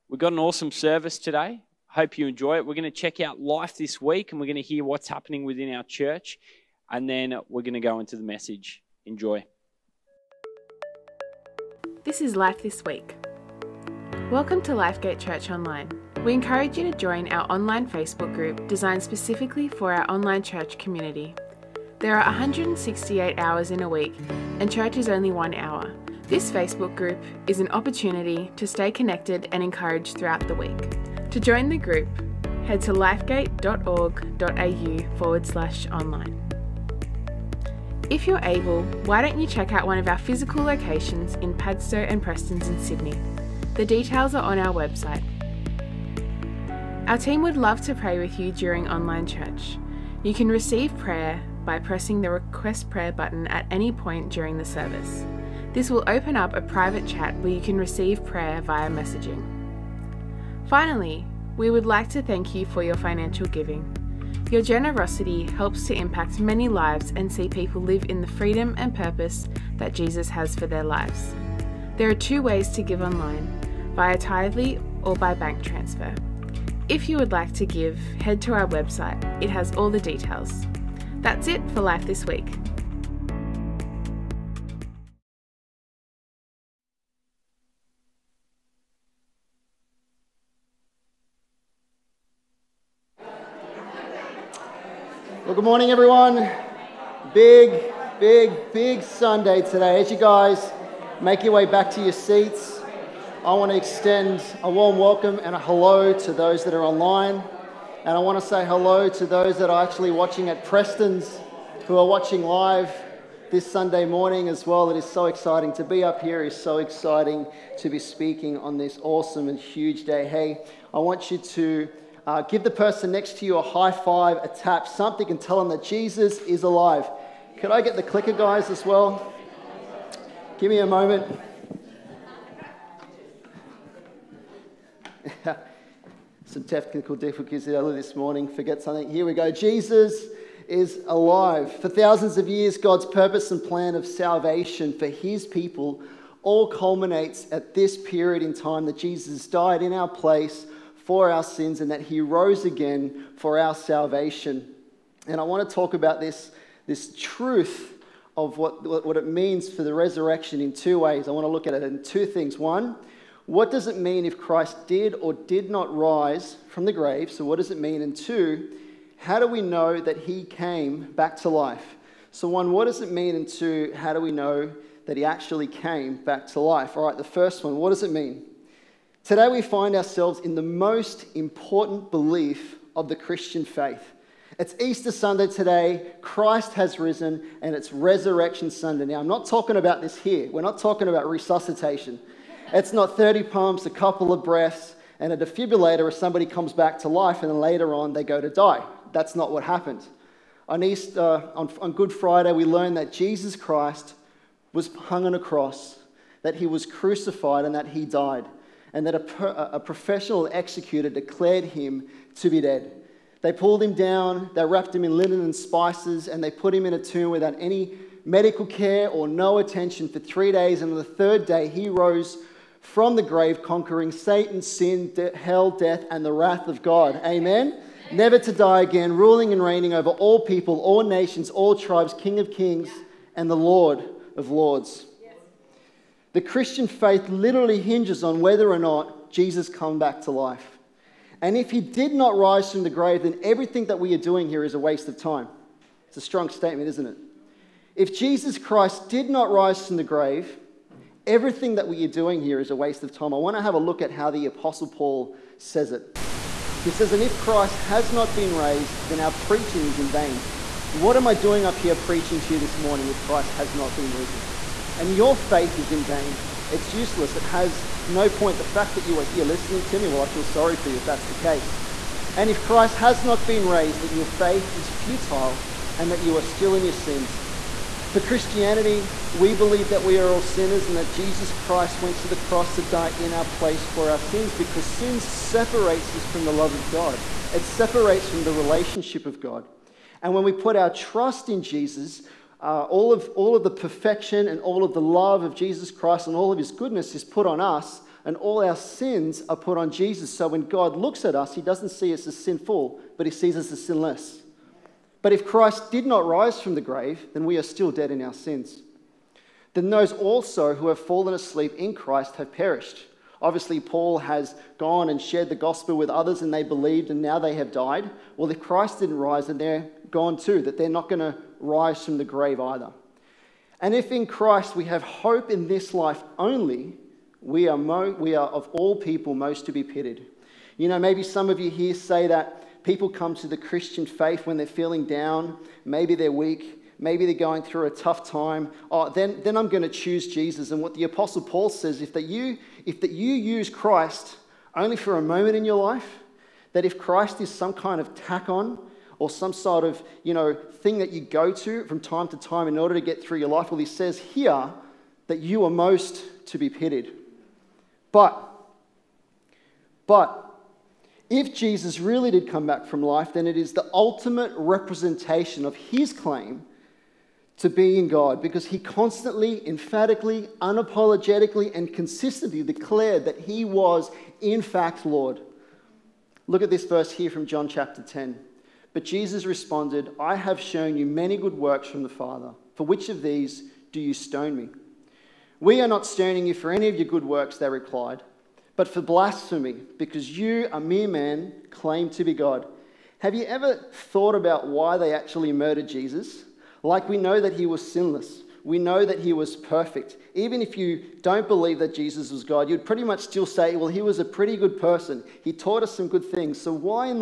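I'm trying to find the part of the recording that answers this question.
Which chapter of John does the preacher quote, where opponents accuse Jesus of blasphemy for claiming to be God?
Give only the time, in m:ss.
6:17.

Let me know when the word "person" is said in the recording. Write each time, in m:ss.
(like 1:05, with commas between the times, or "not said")
2:02, 6:44.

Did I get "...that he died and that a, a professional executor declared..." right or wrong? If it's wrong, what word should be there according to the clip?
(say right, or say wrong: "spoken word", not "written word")
right.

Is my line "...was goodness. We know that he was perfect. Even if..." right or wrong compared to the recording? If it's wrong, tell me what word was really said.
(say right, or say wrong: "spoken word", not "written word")
wrong: "sinless", not "goodness".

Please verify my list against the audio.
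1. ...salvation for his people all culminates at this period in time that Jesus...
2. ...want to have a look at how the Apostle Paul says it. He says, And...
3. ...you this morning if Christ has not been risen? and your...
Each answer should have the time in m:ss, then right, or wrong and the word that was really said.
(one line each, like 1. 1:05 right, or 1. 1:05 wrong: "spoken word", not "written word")
1. 2:24 right
2. 4:13 right
3. 4:22 right.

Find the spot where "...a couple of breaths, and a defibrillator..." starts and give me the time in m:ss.
3:13.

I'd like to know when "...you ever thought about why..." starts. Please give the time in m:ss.
6:33.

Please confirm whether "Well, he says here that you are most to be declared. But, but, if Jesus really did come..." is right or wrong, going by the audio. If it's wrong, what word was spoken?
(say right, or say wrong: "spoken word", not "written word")
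wrong: "pitied", not "declared".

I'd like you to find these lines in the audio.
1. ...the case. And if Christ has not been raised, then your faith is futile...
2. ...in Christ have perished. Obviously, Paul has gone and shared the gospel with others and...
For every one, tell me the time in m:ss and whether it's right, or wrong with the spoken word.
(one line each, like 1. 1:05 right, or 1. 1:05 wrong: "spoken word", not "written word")
1. 4:31 right
2. 5:11 right.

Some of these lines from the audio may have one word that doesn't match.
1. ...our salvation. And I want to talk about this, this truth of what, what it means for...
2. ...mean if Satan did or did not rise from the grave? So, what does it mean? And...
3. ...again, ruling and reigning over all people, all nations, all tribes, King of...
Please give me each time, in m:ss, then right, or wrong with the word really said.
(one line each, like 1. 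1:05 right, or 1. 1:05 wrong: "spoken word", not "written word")
1. 2:33 right
2. 2:43 wrong: "Christ", not "Satan"
3. 3:48 right.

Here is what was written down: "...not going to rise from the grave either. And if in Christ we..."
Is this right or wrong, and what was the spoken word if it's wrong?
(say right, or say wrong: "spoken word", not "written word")
right.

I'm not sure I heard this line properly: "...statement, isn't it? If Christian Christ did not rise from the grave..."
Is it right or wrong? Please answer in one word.
wrong.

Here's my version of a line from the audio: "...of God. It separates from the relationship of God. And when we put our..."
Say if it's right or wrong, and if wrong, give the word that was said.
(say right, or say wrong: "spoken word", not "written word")
right.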